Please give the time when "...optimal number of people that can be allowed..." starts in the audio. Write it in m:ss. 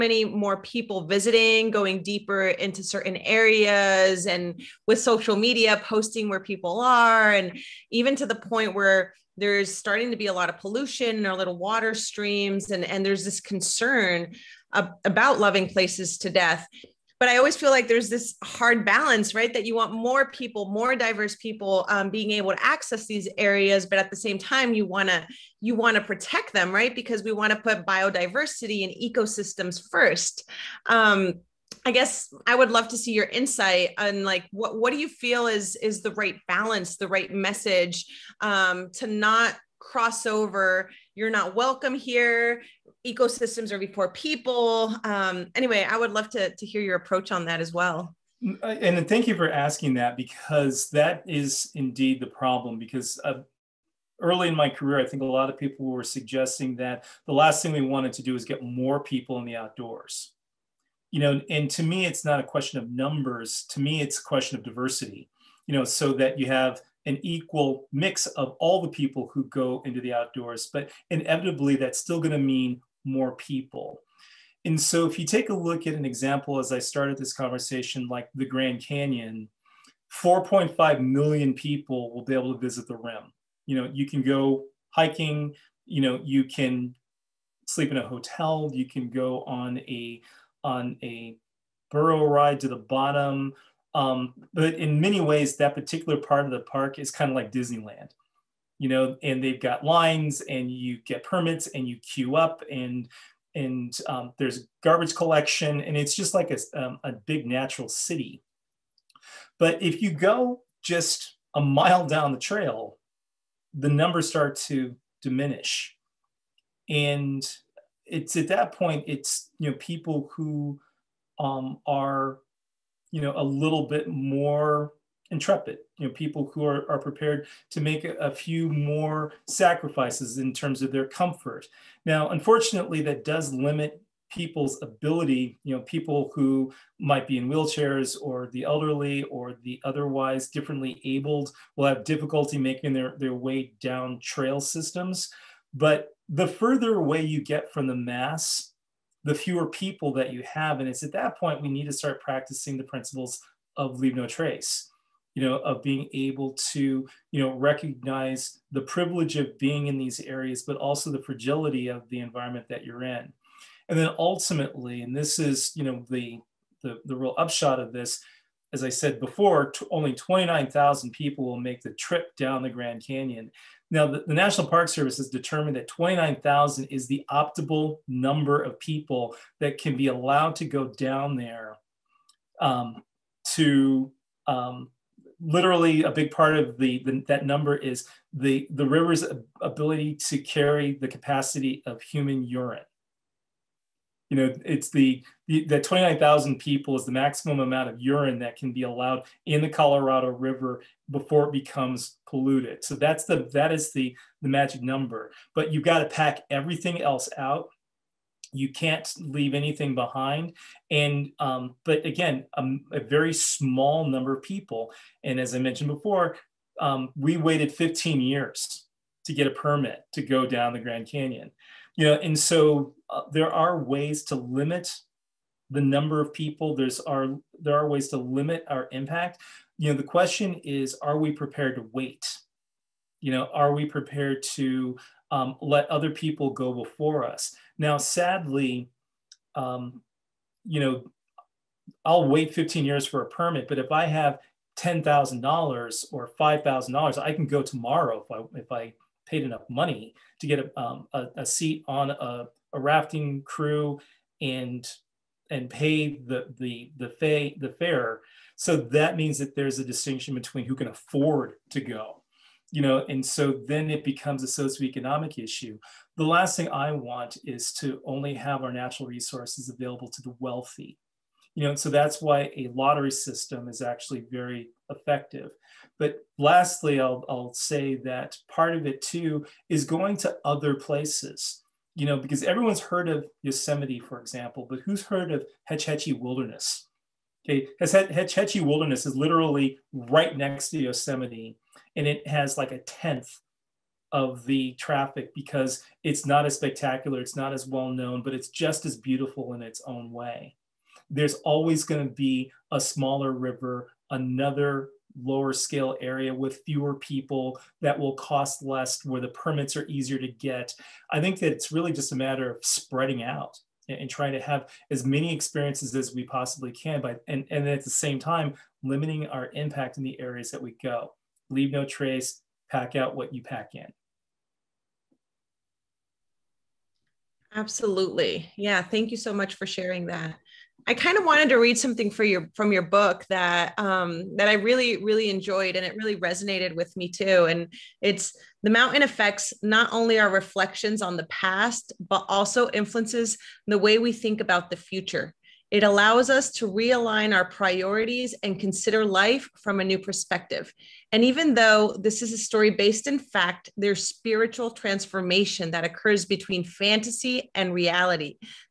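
2:57.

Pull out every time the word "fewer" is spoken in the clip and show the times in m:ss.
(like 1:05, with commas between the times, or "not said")
2:29, 5:06.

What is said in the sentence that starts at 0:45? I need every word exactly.
Um, anyway, I would love to, to hear your approach on that as well.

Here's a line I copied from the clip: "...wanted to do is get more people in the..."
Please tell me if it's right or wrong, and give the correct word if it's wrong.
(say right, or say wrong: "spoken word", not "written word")
right.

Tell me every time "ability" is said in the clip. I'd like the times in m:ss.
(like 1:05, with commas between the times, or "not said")
2:14, 3:09.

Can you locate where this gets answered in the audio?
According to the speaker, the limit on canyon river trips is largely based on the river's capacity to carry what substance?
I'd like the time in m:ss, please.
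3:12.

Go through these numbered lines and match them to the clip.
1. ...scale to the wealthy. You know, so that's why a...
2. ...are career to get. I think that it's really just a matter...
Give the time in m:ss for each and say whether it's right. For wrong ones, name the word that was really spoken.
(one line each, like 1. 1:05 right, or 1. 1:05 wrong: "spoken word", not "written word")
1. 4:29 wrong: "available", not "scale"
2. 5:09 wrong: "easier", not "career".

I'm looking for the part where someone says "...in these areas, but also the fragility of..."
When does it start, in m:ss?
2:39.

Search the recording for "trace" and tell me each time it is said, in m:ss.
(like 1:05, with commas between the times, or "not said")
2:34, 5:21.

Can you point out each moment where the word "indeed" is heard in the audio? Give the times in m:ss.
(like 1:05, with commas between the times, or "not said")
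0:51.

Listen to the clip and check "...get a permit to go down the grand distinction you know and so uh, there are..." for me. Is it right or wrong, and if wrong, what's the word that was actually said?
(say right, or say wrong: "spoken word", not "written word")
wrong: "canyon", not "distinction".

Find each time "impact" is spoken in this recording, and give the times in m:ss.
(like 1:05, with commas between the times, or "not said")
3:48, 5:19.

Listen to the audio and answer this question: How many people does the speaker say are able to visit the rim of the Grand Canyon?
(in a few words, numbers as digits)
4.5 million.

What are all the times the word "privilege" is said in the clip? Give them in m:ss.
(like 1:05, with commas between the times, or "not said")
2:38.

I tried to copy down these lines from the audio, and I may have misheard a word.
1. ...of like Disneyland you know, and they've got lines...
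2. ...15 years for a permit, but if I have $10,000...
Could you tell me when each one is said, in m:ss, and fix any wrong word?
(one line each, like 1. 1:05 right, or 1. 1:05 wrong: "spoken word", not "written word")
1. 1:37 right
2. 4:02 right.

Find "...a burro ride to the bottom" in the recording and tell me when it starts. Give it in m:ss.
1:31.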